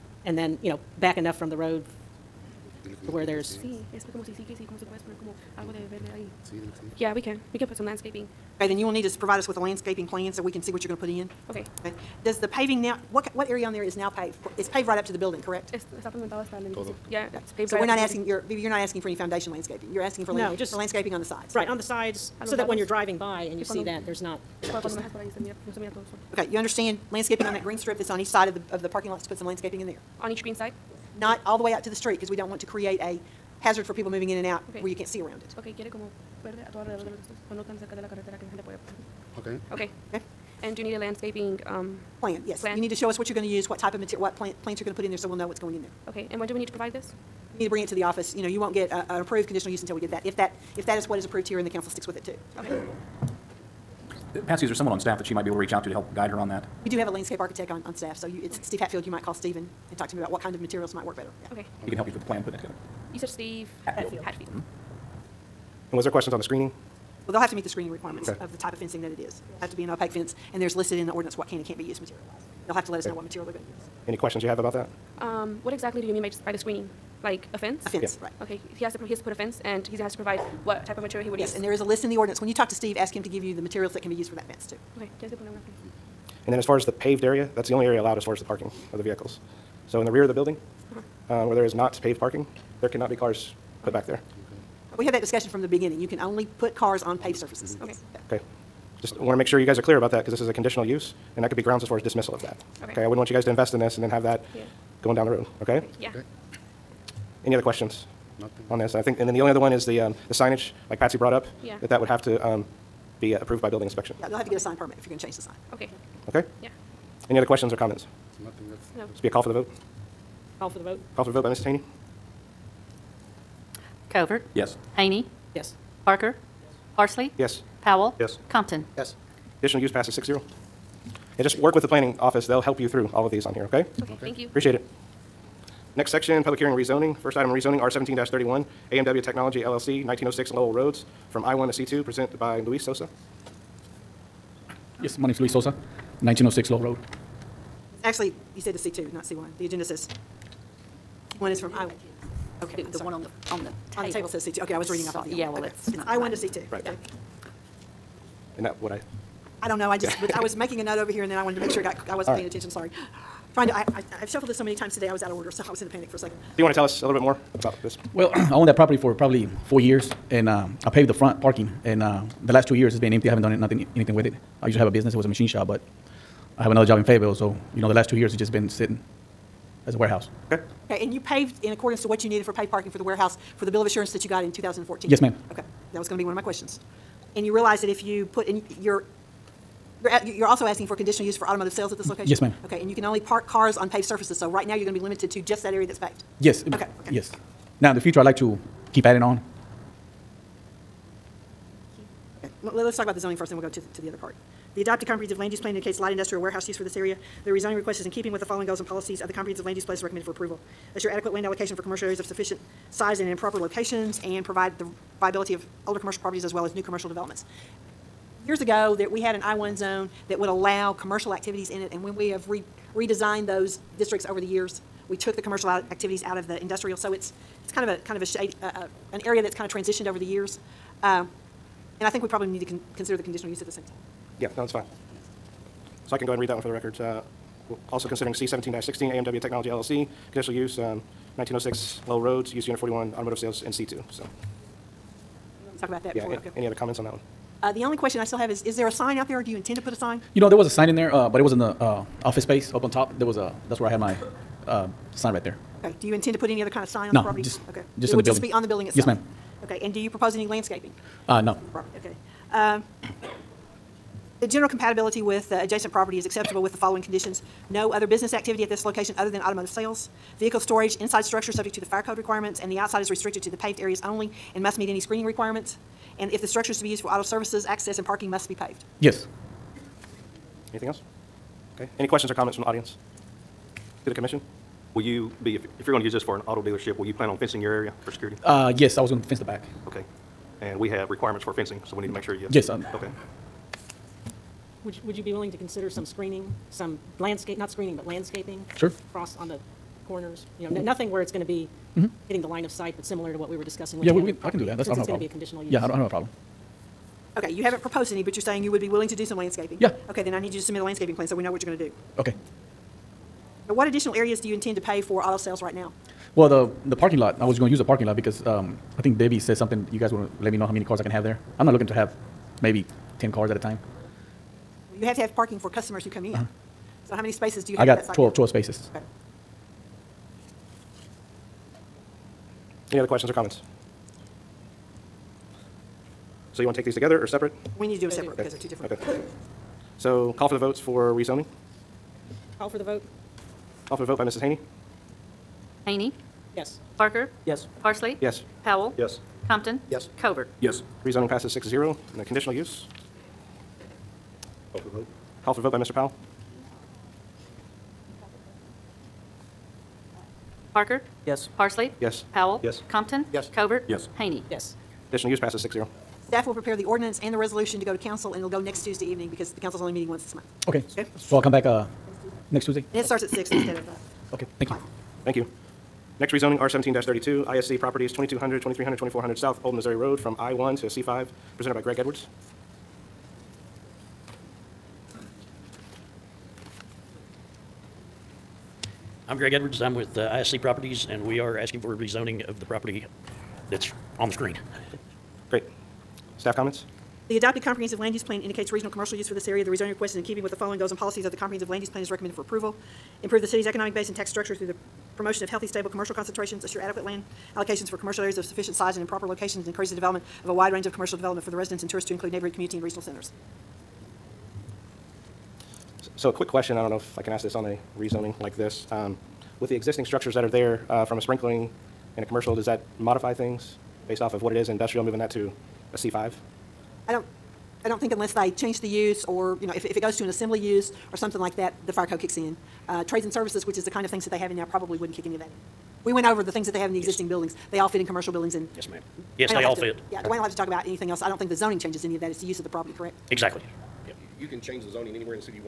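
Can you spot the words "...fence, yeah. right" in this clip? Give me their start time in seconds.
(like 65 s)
77 s.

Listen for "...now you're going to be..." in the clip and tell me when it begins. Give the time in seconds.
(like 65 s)
194 s.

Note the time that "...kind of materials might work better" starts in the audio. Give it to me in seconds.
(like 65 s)
60 s.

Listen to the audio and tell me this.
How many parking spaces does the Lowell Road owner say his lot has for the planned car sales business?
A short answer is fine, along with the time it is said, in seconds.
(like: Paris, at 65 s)
12, at 328 s.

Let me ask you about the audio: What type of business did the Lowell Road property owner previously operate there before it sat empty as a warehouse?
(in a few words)
Machine shop.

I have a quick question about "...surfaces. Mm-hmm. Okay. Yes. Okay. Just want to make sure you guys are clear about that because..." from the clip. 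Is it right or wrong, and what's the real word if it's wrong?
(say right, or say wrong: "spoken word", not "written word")
right.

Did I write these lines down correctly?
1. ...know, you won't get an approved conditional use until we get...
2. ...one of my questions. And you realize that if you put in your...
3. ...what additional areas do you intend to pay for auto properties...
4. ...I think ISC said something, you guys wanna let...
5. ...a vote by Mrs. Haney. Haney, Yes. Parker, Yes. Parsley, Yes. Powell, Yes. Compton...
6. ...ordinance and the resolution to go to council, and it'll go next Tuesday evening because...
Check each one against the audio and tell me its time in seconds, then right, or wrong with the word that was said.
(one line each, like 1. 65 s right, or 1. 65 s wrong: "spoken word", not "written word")
1. 48 s right
2. 186 s right
3. 313 s wrong: "sales", not "properties"
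4. 318 s wrong: "Debbie", not "ISC"
5. 344 s right
6. 366 s right.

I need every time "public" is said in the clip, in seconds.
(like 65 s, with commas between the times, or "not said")
136 s.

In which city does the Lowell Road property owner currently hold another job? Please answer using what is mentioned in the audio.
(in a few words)
Fayetteville.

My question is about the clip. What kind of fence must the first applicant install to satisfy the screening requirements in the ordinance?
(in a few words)
Opaque fence.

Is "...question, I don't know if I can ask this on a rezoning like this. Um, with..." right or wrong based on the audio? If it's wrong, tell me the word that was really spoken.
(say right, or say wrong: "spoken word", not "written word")
right.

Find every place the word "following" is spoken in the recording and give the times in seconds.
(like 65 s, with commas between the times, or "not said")
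208 s, 266 s, 400 s.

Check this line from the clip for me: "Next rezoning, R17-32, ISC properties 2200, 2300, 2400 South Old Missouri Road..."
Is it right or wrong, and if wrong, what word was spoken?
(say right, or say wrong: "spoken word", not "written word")
right.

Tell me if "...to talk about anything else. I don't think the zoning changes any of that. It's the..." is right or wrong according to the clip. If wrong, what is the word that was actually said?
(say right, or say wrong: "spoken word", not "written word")
right.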